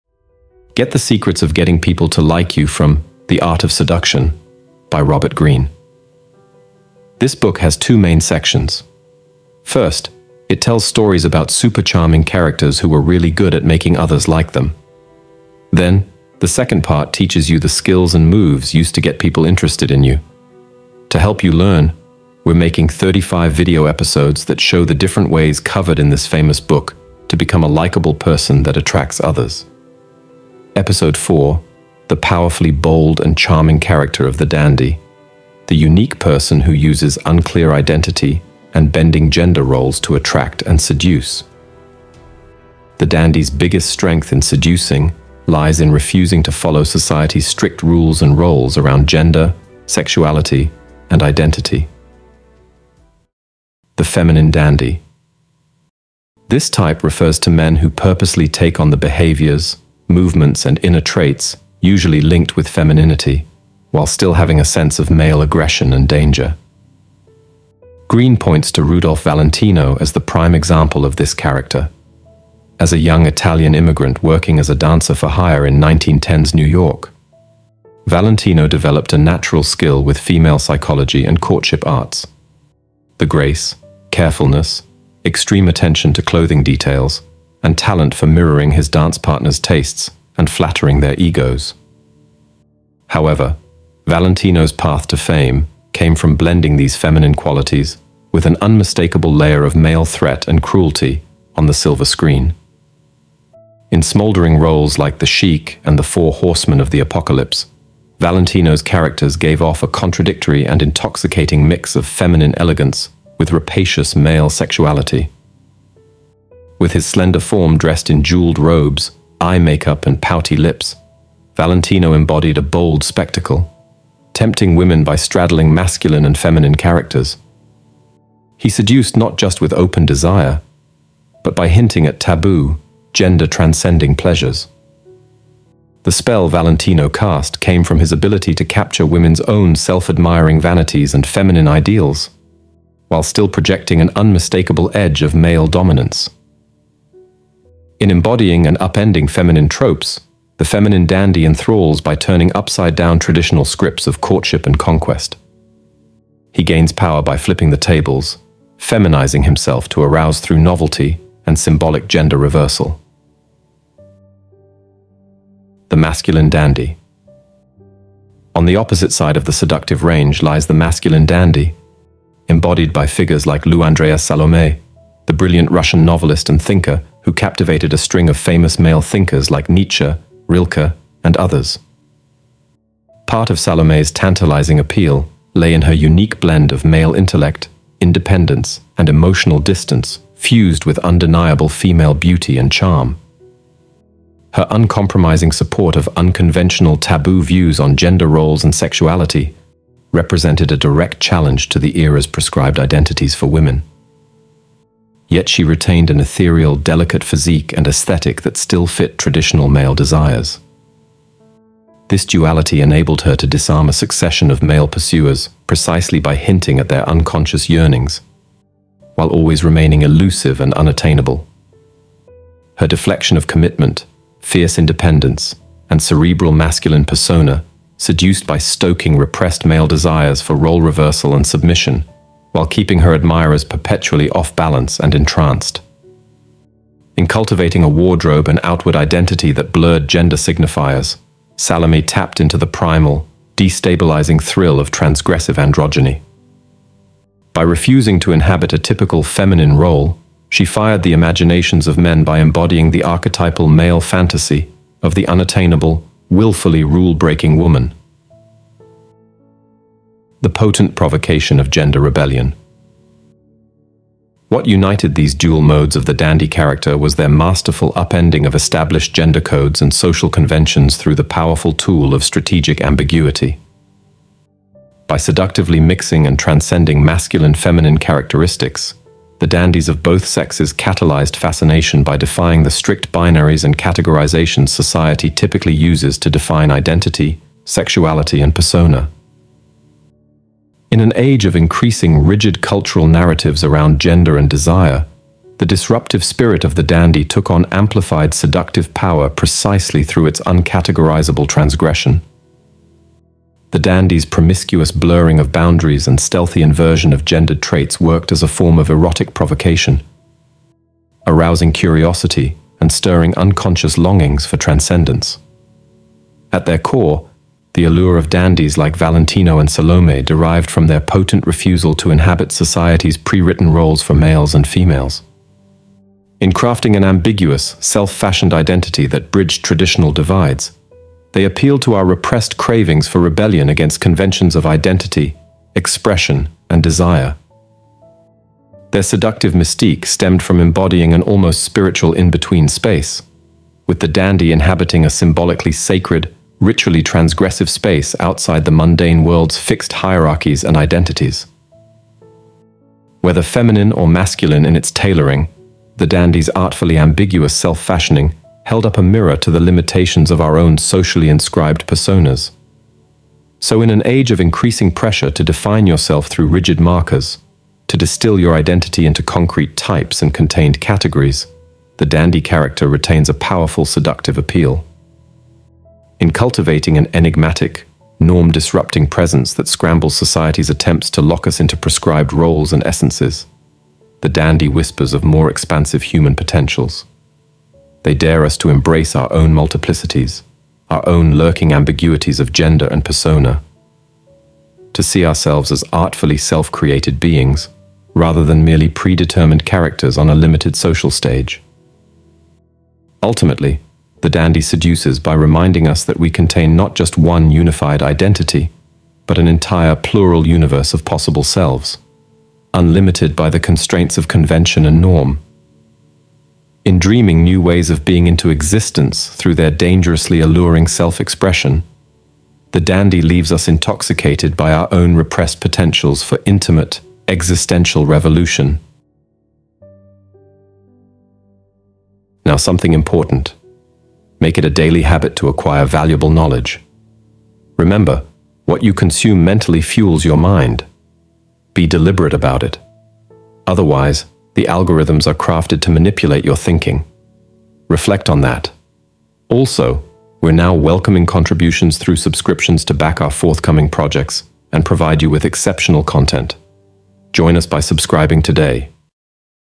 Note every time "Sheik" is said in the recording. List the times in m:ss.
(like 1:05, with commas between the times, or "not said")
1:45.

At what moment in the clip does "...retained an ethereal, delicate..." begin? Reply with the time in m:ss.
3:25.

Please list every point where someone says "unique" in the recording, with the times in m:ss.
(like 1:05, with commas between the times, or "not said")
0:35, 3:05.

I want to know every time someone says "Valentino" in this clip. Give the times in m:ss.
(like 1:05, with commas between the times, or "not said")
1:09, 1:18, 1:34, 1:48, 2:01, 2:16, 5:18.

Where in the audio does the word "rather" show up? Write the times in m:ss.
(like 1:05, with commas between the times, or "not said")
6:38.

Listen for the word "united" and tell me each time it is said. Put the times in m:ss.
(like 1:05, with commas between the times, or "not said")
4:24.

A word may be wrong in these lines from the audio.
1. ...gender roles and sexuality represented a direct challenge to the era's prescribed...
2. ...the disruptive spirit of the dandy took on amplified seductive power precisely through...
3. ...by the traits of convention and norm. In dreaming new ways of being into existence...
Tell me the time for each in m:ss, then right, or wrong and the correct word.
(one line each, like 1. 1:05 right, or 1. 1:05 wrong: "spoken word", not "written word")
1. 3:17 right
2. 4:55 right
3. 6:53 wrong: "constraints", not "traits".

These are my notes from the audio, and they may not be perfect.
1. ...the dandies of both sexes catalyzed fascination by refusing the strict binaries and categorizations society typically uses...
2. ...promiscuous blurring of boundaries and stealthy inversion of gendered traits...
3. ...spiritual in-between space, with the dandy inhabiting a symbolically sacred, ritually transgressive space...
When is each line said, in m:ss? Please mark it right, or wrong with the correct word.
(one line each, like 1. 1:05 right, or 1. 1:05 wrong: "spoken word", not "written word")
1. 4:39 wrong: "defying", not "refusing"
2. 5:04 right
3. 5:41 right.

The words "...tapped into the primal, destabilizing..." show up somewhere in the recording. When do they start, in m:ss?
4:02.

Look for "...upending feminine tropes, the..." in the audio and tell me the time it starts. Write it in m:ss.
2:28.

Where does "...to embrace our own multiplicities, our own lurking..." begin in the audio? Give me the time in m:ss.
6:28.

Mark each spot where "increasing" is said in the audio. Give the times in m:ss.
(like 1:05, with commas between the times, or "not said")
4:51, 6:04.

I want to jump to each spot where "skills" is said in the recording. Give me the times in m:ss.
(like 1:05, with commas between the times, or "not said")
0:17, 1:19.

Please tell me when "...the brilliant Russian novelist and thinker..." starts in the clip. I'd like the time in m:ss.
2:55.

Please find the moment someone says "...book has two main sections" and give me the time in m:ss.
0:07.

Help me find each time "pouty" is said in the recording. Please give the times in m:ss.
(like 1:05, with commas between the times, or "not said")
2:00.